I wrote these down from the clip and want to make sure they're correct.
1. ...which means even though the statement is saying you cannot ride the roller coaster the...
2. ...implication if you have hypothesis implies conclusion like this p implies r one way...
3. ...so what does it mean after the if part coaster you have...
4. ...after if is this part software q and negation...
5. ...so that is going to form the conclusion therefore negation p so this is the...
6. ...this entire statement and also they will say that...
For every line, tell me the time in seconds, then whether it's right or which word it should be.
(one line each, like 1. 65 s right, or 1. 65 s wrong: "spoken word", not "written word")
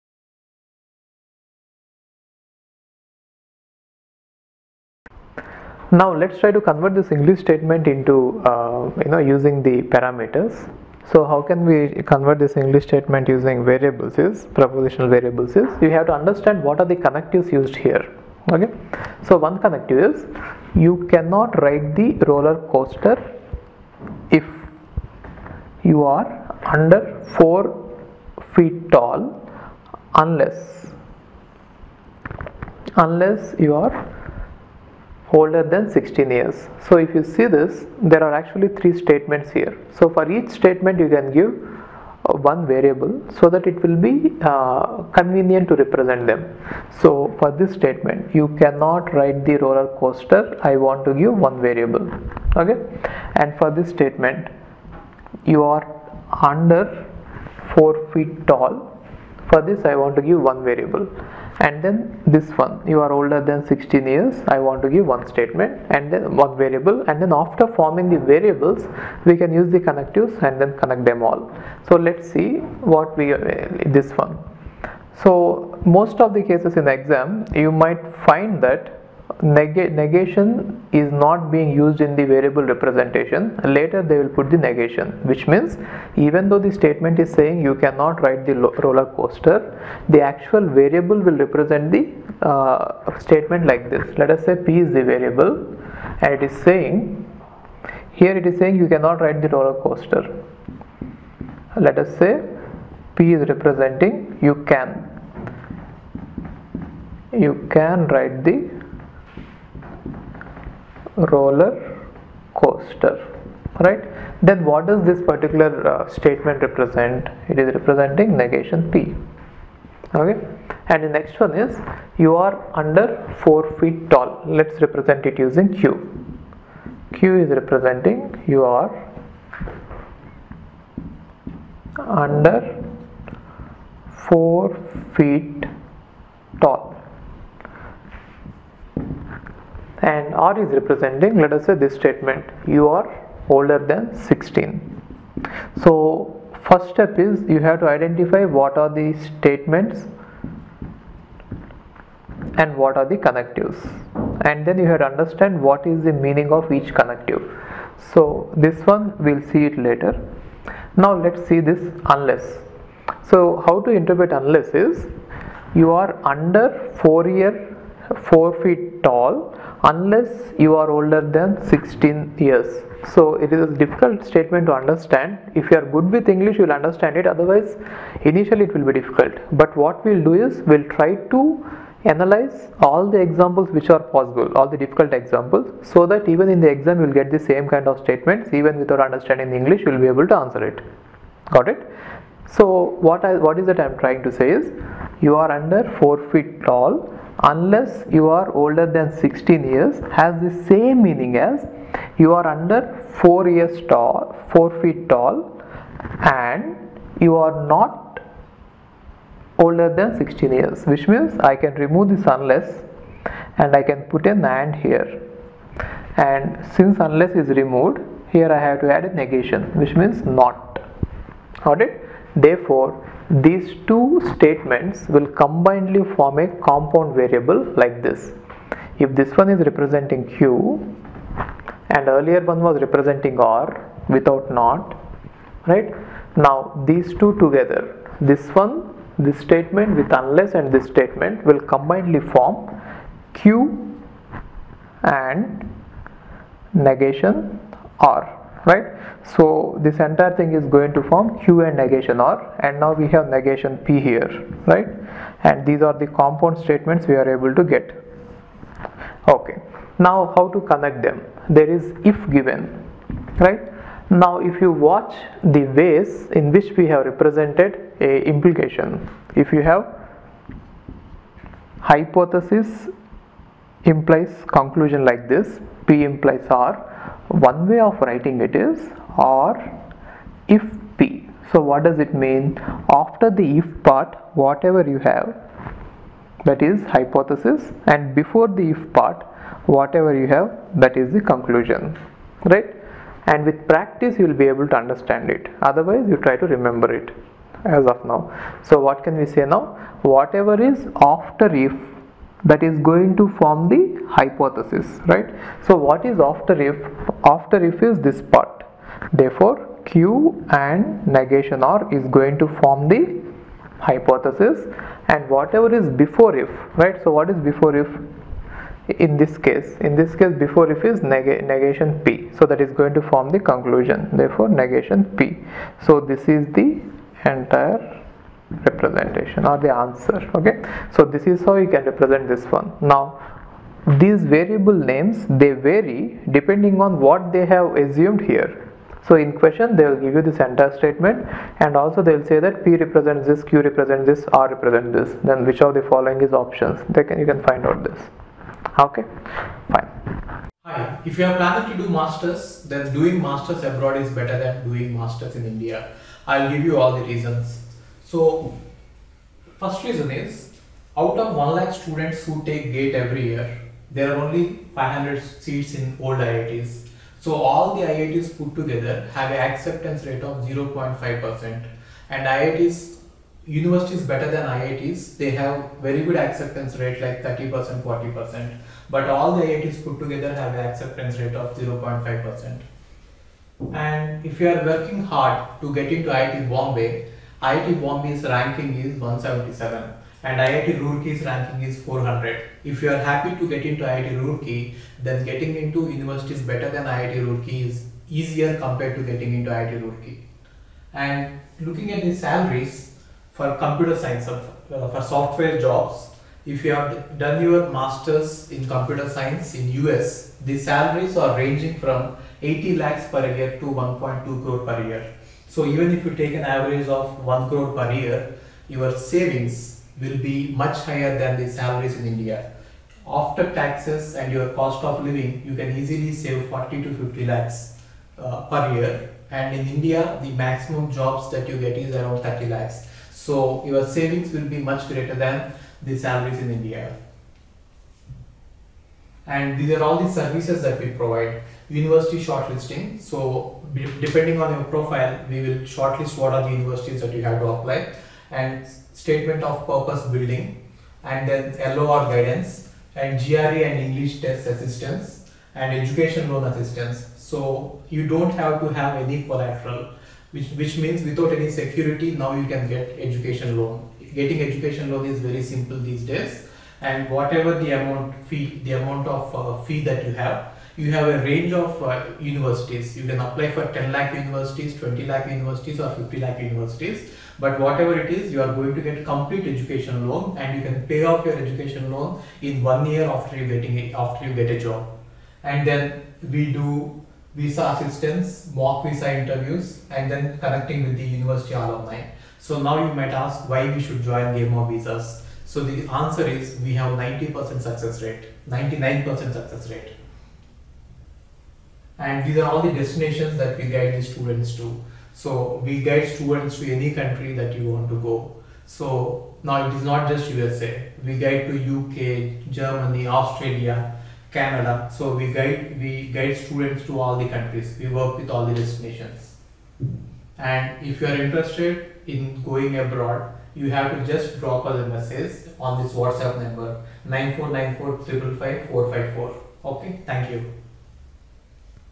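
1. 85 s right
2. 268 s right
3. 281 s wrong: "whatever", not "coaster"
4. 307 s wrong: "therefore", not "software"
5. 322 s right
6. 340 s right.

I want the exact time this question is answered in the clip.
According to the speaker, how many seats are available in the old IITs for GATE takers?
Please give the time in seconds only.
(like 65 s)
364 s.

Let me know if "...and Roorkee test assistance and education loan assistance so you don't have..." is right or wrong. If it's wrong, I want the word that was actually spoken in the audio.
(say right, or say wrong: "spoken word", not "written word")
wrong: "English", not "Roorkee".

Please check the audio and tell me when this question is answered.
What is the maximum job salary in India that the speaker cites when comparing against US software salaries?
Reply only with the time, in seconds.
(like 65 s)
432 s.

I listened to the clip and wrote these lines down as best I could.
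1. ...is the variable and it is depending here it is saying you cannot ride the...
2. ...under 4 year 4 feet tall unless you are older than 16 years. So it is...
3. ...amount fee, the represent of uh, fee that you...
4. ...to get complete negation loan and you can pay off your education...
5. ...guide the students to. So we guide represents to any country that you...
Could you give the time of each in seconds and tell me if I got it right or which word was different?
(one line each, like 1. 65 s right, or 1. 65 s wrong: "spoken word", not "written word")
1. 94 s wrong: "saying", not "depending"
2. 166 s right
3. 467 s wrong: "amount", not "represent"
4. 478 s wrong: "education", not "negation"
5. 503 s wrong: "students", not "represents".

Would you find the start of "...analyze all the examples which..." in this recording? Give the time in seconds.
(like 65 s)
182 s.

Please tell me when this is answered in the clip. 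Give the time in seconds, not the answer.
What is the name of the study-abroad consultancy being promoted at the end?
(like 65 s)
494 s.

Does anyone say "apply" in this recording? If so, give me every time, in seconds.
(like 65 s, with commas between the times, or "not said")
447 s, 473 s.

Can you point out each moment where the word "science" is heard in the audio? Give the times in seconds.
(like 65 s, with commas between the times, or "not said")
403 s, 409 s.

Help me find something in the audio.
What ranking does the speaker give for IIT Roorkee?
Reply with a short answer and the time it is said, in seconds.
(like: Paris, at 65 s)
400, at 391 s.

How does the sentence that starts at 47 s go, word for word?
So for this statement, you cannot write the roller coaster.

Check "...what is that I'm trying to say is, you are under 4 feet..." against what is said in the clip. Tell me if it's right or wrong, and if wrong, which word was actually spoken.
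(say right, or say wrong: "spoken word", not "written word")
right.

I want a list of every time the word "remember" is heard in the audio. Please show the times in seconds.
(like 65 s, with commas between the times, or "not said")
296 s.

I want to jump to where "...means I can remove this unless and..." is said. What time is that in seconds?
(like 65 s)
211 s.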